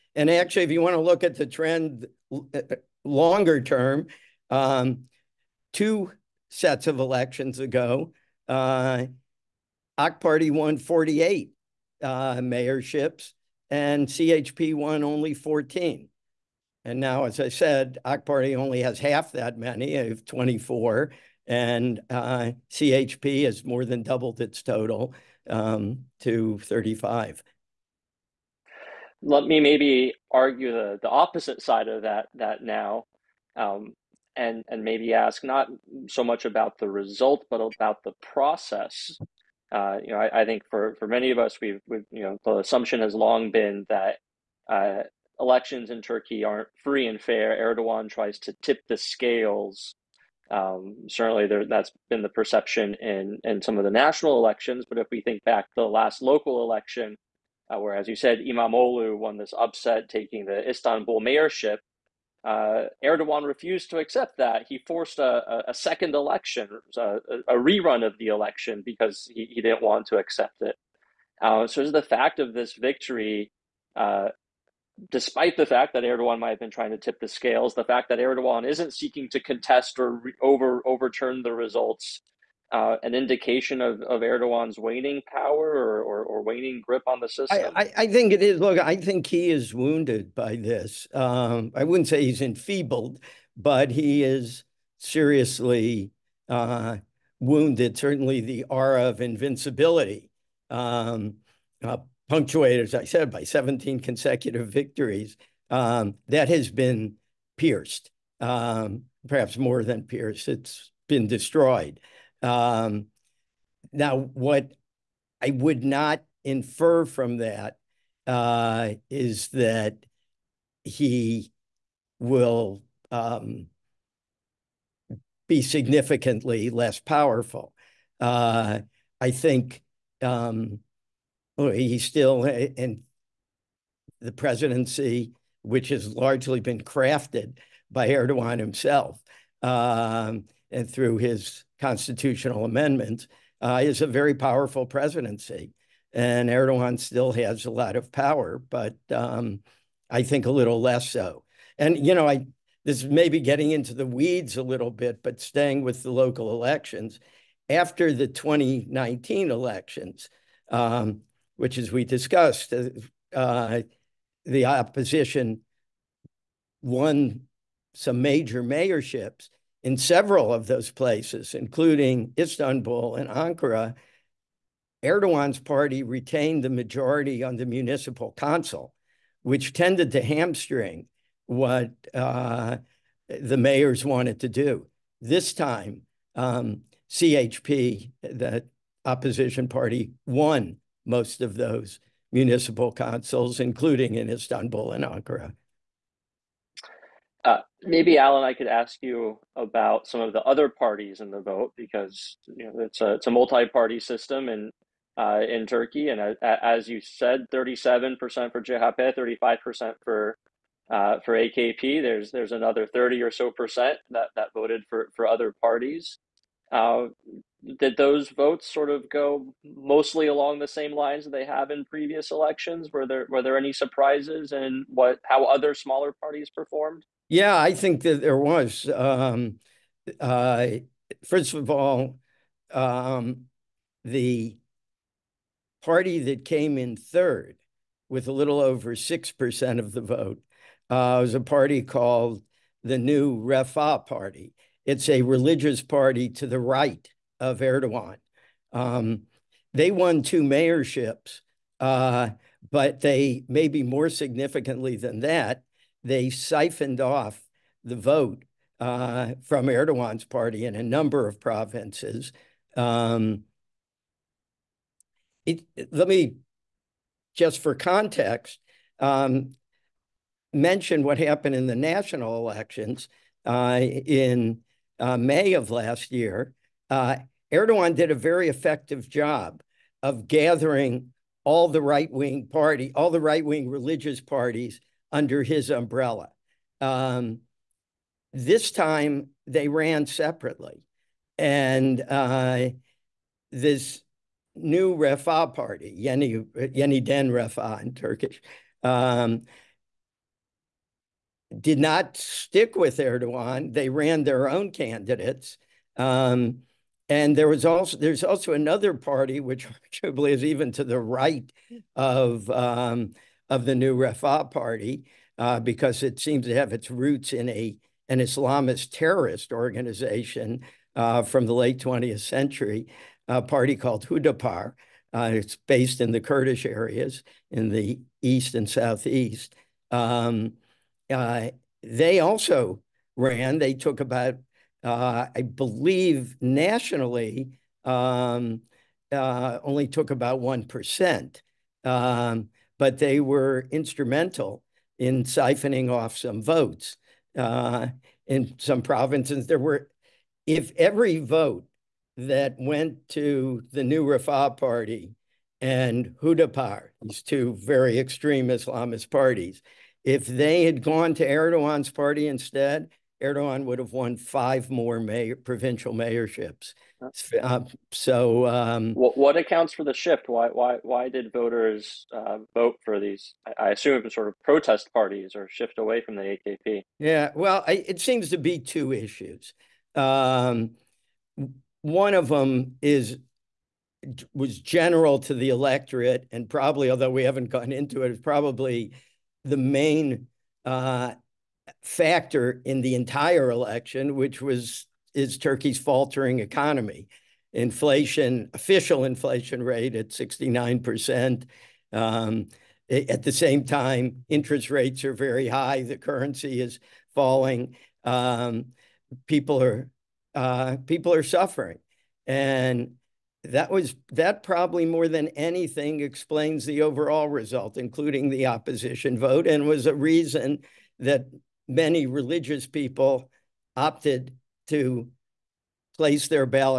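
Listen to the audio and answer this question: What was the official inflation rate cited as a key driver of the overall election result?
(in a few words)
69%.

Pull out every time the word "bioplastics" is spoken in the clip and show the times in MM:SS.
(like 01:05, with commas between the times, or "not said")
not said.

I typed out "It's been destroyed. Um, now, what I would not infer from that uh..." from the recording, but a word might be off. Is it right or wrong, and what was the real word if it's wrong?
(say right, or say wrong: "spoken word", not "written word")
right.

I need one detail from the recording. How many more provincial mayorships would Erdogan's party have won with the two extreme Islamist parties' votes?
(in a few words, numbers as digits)
5.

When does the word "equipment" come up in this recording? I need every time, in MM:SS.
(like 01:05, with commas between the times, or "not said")
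not said.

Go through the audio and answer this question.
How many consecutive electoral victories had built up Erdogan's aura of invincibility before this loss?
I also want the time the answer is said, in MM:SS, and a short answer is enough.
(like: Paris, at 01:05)
17, at 01:43.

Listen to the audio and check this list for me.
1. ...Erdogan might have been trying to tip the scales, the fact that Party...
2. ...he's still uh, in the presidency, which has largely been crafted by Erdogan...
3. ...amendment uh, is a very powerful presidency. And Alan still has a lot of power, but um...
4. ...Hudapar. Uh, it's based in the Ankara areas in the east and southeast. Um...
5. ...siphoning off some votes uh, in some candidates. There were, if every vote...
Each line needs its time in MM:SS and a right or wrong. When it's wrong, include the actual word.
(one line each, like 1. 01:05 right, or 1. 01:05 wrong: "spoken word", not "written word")
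1. 01:16 wrong: "Erdogan", not "Party"
2. 02:11 right
3. 02:22 wrong: "Erdogan", not "Alan"
4. 05:24 wrong: "Kurdish", not "Ankara"
5. 05:45 wrong: "provinces", not "candidates".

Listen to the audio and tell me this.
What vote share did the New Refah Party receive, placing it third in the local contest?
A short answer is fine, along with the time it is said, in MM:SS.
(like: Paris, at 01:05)
a little over 6%, at 03:58.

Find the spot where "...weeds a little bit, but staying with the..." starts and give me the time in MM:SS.
02:34.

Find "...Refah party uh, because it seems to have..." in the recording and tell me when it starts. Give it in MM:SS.
05:13.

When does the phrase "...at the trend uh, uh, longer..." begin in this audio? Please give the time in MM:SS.
00:01.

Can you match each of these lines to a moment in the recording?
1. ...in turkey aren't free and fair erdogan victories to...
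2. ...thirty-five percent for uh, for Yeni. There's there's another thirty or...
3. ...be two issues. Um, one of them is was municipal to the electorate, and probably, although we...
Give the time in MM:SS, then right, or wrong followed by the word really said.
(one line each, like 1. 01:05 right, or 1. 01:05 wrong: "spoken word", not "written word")
1. 00:45 wrong: "tries", not "victories"
2. 03:29 wrong: "AKP", not "Yeni"
3. 06:18 wrong: "general", not "municipal".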